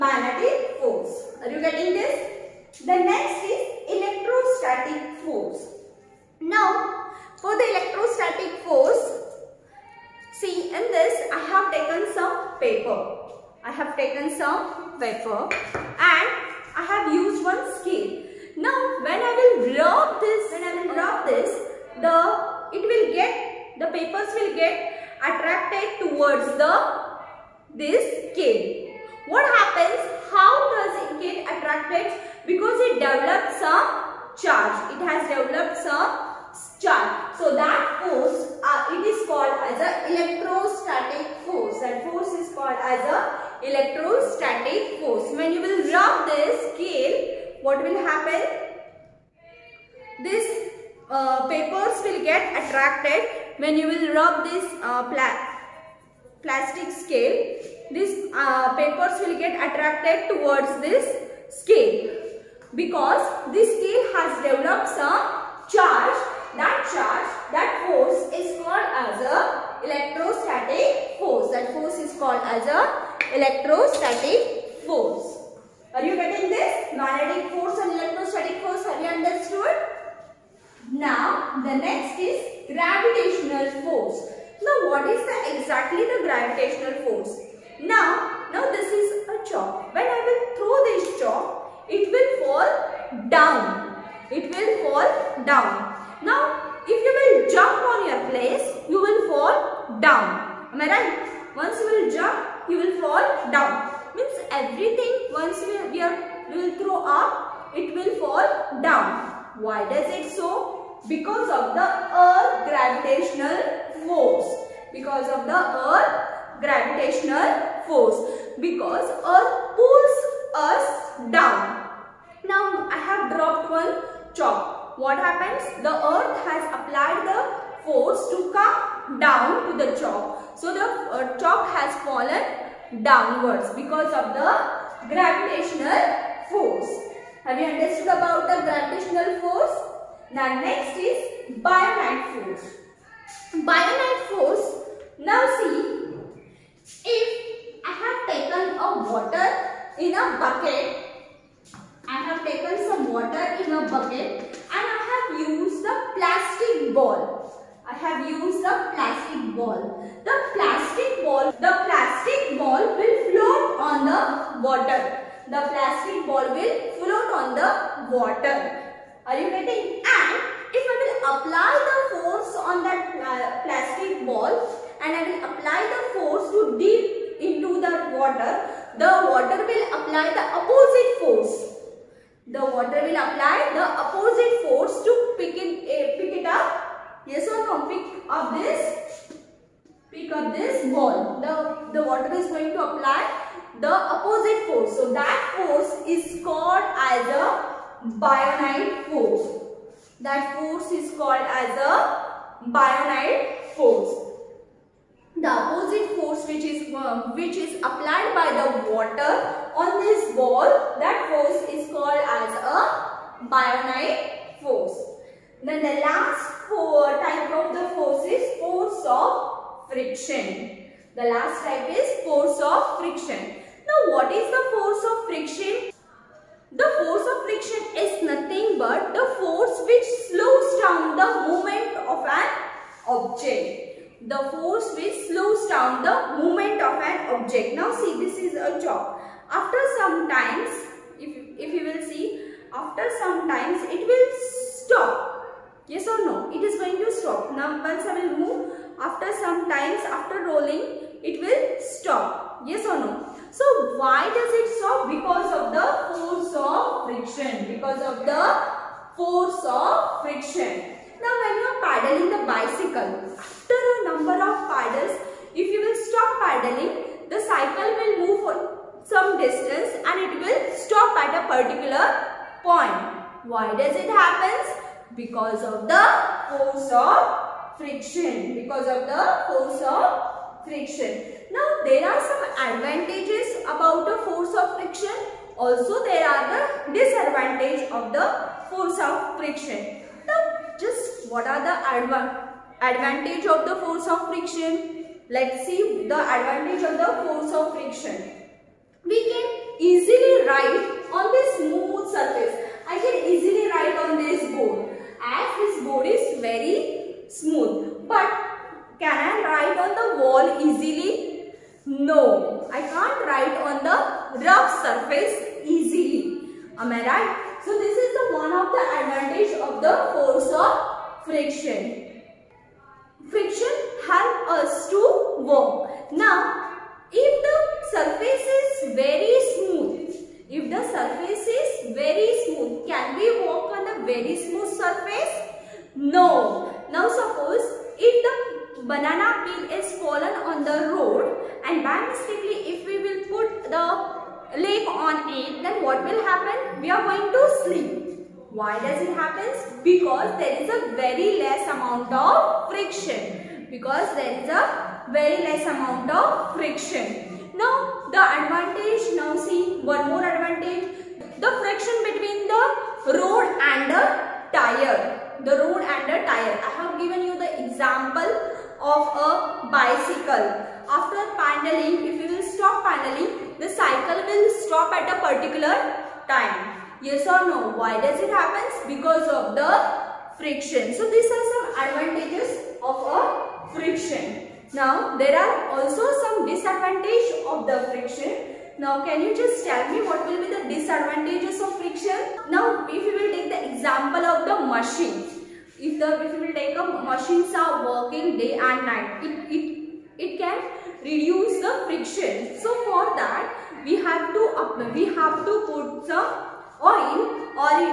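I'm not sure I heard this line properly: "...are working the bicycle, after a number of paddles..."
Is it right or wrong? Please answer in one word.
wrong.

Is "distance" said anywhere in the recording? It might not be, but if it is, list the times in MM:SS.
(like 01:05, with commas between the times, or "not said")
04:29.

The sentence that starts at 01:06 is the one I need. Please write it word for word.
That charge, that force is called as a electrostatic force.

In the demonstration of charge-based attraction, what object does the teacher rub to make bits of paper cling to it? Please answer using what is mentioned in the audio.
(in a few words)
plastic scale.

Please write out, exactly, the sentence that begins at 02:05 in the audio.
The earth has applied the force to come down to the chalk.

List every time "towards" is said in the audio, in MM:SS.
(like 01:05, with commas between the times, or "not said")
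00:26, 01:00.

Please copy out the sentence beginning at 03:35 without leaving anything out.
Then the last four type of the force is force of friction.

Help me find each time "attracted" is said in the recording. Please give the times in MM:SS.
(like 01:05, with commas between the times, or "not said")
00:25, 00:31, 00:52, 00:59.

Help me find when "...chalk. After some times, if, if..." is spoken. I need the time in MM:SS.
03:58.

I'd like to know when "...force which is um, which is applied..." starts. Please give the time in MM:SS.
03:26.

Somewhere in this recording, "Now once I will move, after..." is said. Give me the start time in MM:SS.
04:07.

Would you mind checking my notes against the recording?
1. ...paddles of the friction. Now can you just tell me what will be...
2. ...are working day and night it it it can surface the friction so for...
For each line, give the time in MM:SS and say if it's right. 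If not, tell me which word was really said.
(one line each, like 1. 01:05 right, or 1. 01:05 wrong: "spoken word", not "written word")
1. 06:26 wrong: "disadvantages", not "paddles"
2. 06:37 wrong: "reduce", not "surface".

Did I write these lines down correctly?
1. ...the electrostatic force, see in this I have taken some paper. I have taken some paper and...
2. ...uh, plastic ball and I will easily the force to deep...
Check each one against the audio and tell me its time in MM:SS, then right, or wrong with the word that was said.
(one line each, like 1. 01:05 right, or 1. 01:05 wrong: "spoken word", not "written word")
1. 00:07 right
2. 02:53 wrong: "apply", not "easily".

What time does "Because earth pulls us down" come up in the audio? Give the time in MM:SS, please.
01:58.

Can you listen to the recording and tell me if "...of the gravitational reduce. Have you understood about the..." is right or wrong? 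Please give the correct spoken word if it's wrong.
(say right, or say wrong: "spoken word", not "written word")
wrong: "force", not "reduce".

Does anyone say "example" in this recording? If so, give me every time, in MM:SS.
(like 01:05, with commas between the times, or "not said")
06:07, 06:33.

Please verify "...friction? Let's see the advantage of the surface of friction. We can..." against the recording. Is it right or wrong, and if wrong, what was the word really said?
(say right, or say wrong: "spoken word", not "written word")
wrong: "force", not "surface".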